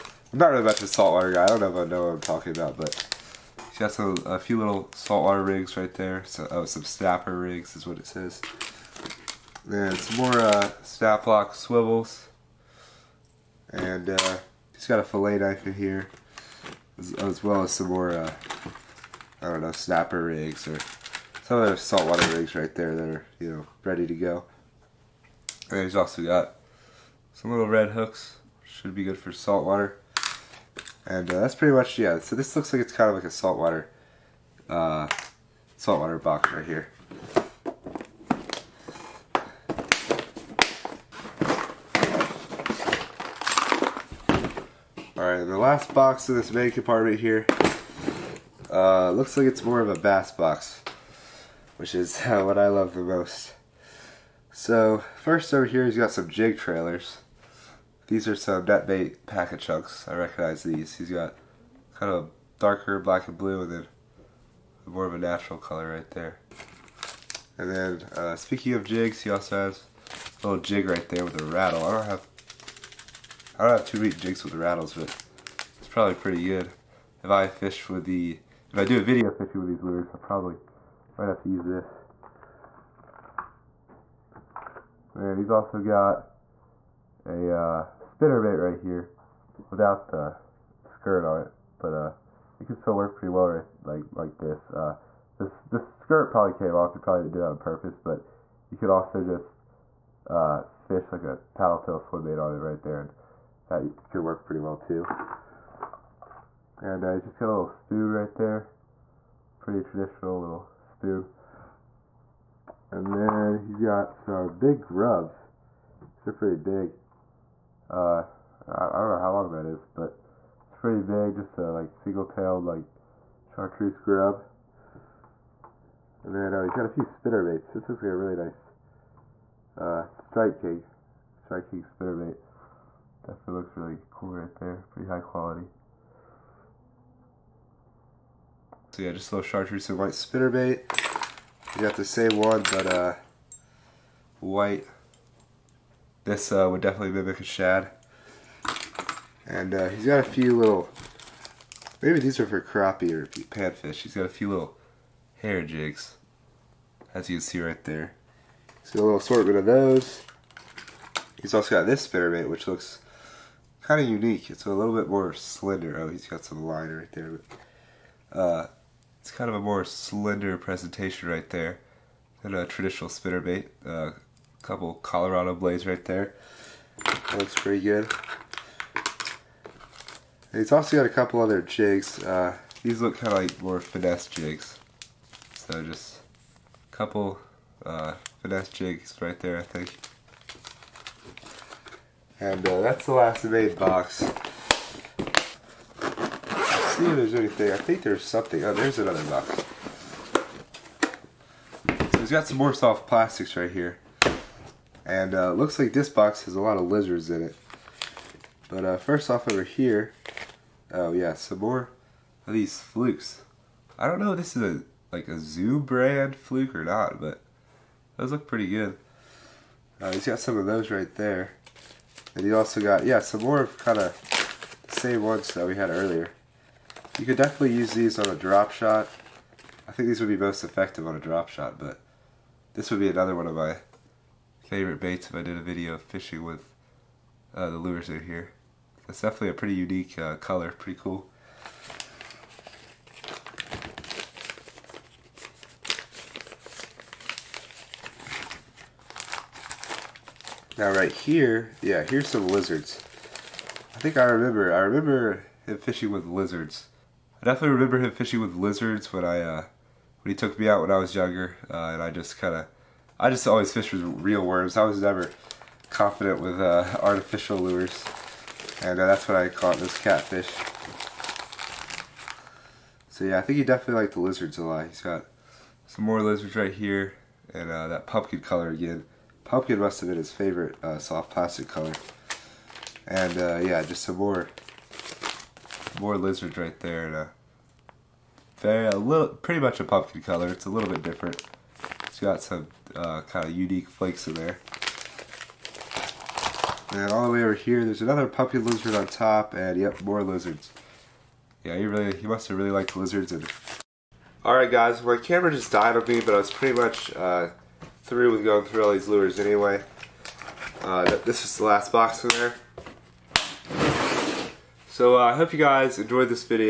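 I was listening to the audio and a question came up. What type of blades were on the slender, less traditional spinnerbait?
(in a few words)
Colorado blades.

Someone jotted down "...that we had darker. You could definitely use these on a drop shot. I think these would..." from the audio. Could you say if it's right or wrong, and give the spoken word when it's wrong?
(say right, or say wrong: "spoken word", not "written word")
wrong: "earlier", not "darker".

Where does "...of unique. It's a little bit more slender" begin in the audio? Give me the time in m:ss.
2:43.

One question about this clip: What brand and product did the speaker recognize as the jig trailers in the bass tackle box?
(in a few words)
NetBait Paca Chunks.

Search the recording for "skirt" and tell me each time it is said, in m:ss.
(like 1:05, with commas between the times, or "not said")
1:30, 1:35.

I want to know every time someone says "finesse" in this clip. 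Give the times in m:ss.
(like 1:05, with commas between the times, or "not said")
3:03, 3:08.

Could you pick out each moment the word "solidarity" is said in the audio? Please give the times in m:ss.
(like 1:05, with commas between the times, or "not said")
not said.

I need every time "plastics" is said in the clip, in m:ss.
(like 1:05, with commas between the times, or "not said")
3:23, 4:41.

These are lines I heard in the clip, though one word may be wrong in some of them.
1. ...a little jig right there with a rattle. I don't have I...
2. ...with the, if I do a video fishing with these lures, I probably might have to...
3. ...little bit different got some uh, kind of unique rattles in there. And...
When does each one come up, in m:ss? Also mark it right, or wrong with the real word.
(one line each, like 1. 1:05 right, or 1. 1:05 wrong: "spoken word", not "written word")
1. 1:10 right
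2. 1:17 right
3. 4:50 wrong: "flakes", not "rattles".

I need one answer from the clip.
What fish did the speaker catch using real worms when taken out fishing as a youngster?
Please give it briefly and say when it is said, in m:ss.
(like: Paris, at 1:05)
catfish, at 4:29.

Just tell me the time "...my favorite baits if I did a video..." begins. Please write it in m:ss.
3:53.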